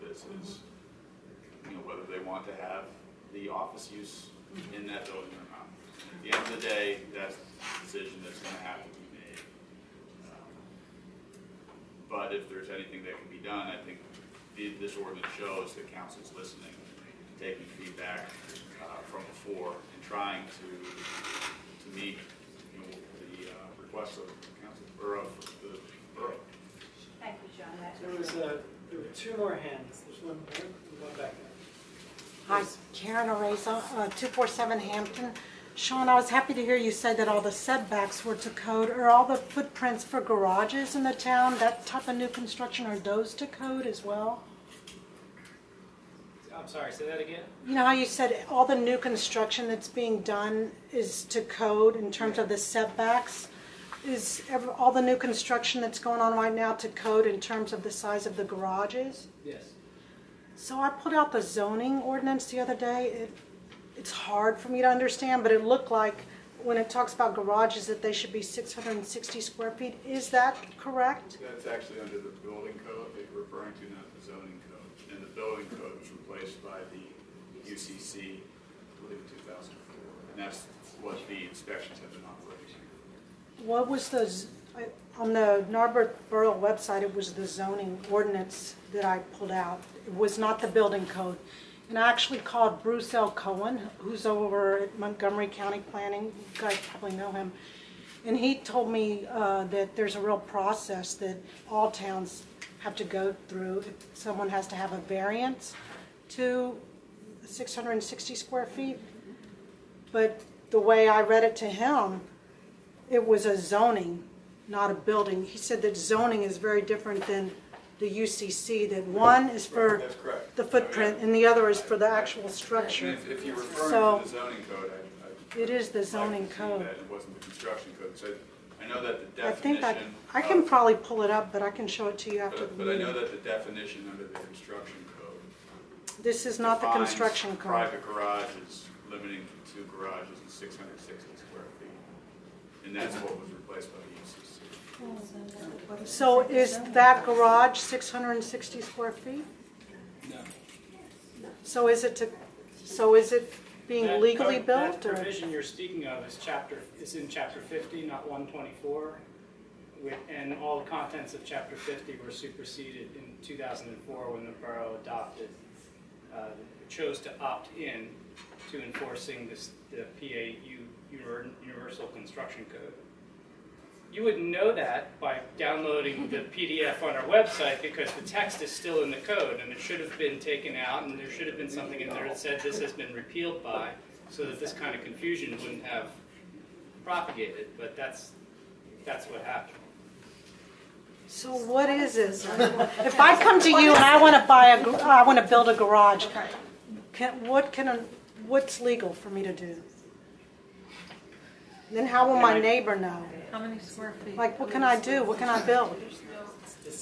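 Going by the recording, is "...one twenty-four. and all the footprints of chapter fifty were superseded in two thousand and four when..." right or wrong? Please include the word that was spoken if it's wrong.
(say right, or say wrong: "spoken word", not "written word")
wrong: "contents", not "footprints".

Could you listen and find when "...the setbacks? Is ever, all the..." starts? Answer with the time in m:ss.
0:52.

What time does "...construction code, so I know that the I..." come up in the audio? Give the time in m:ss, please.
2:07.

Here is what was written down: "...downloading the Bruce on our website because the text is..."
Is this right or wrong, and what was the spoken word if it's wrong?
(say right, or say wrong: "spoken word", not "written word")
wrong: "PDF", not "Bruce".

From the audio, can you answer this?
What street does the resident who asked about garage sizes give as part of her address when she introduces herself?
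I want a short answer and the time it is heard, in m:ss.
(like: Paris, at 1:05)
Hampton, at 0:34.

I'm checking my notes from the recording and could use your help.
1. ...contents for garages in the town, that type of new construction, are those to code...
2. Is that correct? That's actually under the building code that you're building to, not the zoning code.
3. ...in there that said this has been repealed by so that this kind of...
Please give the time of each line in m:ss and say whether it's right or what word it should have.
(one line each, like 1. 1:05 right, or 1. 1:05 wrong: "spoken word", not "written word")
1. 0:39 wrong: "footprints", not "contents"
2. 1:10 wrong: "referring", not "building"
3. 3:02 right.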